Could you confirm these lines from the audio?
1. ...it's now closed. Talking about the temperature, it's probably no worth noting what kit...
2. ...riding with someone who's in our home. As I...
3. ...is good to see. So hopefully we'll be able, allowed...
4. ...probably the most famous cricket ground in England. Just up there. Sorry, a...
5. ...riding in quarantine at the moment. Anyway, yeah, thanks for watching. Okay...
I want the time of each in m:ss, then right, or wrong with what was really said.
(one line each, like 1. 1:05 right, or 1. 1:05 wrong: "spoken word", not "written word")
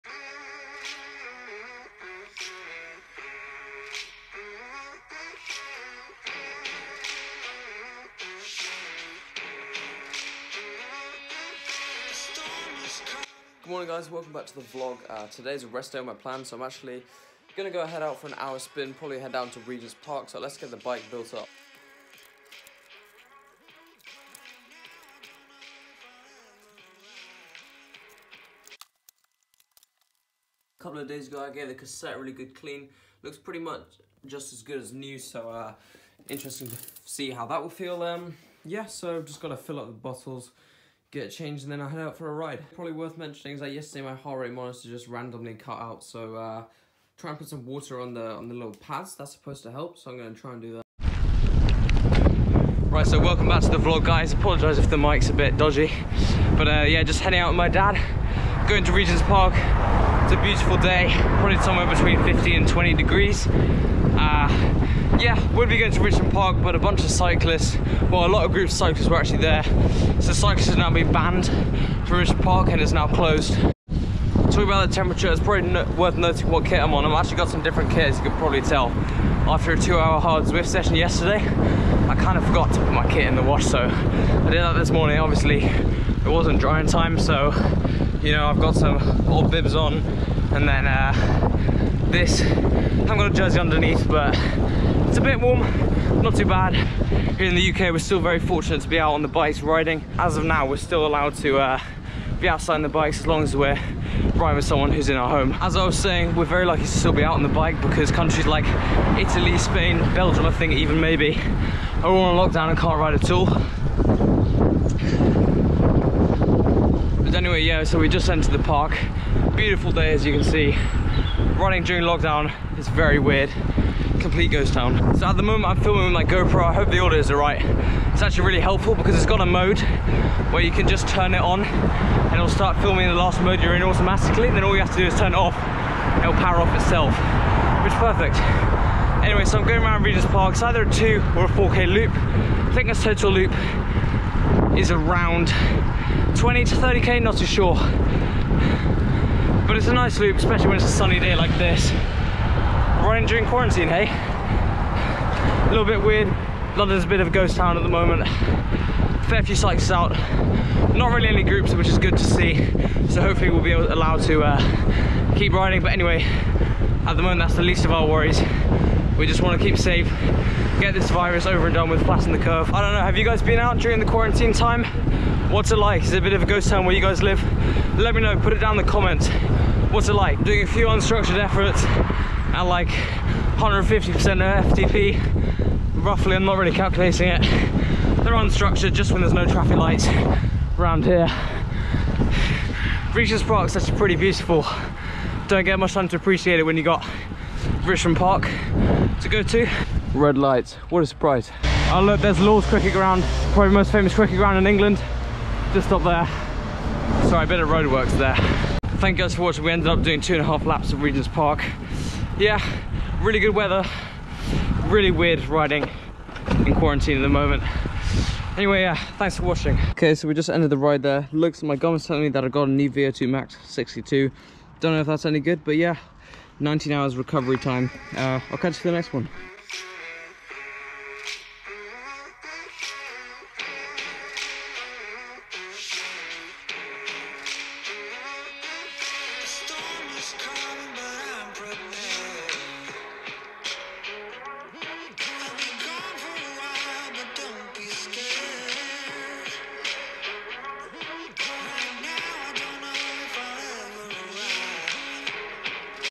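1. 1:12 right
2. 1:44 right
3. 2:41 right
4. 3:23 right
5. 3:35 right.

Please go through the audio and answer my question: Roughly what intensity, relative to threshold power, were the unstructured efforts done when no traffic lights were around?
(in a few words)
150% of FTP.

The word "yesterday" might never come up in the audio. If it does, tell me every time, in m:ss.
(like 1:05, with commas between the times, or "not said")
0:43, 1:20.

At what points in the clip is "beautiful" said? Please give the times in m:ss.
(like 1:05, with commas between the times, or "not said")
1:00, 1:59, 3:14.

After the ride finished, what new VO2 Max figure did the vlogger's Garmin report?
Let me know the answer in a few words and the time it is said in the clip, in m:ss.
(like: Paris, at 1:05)
62, at 3:43.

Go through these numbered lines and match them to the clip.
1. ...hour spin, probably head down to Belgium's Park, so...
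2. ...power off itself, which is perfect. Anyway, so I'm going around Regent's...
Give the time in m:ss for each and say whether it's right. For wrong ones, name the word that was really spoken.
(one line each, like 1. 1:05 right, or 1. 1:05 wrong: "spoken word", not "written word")
1. 0:18 wrong: "Regent", not "Belgium"
2. 2:16 right.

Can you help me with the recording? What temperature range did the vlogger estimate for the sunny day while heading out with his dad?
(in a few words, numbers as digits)
15 to 20 degrees.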